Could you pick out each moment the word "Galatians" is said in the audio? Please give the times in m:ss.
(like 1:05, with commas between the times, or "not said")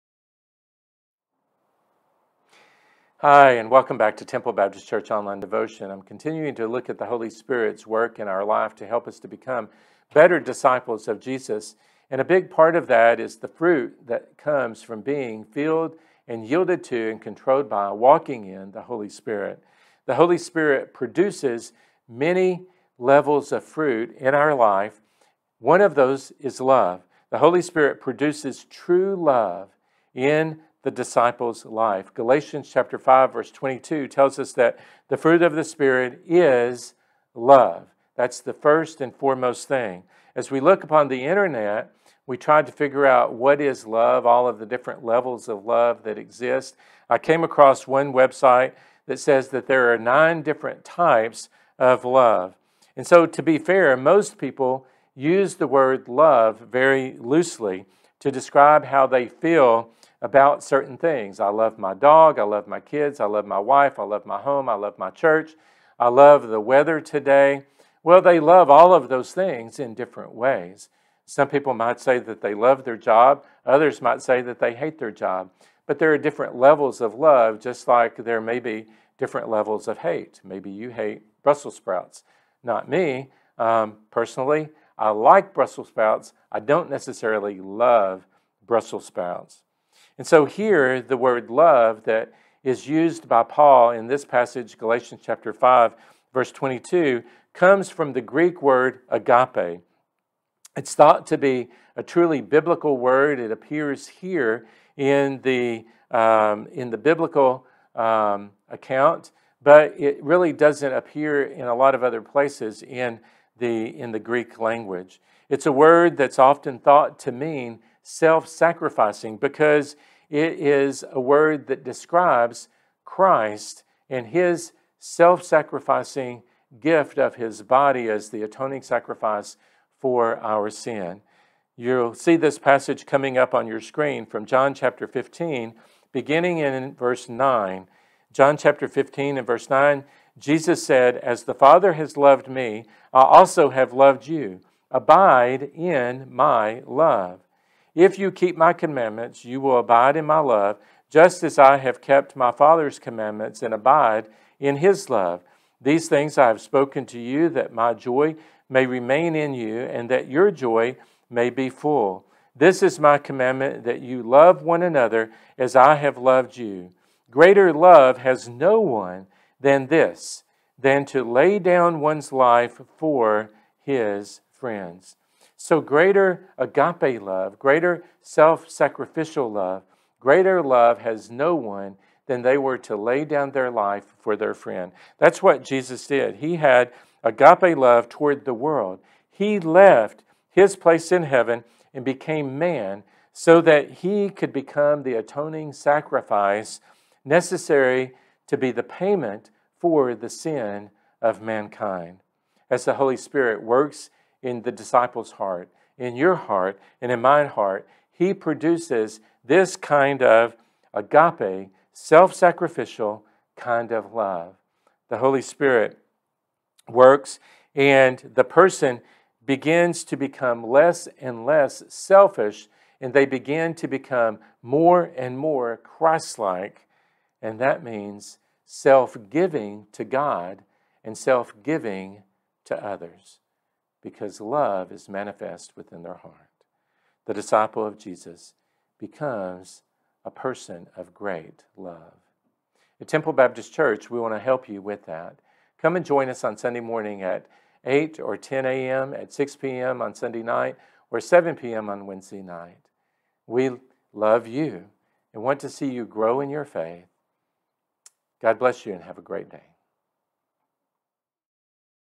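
0:32, 1:34.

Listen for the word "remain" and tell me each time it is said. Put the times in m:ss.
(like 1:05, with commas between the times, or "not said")
2:38.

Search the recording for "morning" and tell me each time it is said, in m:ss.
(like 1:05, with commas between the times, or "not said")
4:06.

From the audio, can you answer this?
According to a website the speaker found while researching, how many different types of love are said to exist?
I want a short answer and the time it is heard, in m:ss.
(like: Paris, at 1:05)
9, at 0:49.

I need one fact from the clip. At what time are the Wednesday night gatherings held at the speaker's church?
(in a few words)
7 p.m.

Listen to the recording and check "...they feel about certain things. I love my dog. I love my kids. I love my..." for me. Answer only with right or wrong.
right.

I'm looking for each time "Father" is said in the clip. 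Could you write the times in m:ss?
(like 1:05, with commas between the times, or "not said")
2:21, 2:32.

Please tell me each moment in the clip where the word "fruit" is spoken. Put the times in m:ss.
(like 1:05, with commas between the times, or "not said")
0:13, 0:23, 0:35.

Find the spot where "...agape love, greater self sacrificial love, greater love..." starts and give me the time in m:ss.
2:56.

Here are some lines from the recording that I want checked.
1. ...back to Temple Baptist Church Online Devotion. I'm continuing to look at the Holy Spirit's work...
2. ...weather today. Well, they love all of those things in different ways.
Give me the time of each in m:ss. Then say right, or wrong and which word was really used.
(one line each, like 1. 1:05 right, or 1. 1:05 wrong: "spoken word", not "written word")
1. 0:03 right
2. 1:06 right.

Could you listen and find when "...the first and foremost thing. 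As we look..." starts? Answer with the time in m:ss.
0:38.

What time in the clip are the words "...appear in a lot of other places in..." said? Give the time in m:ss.
1:50.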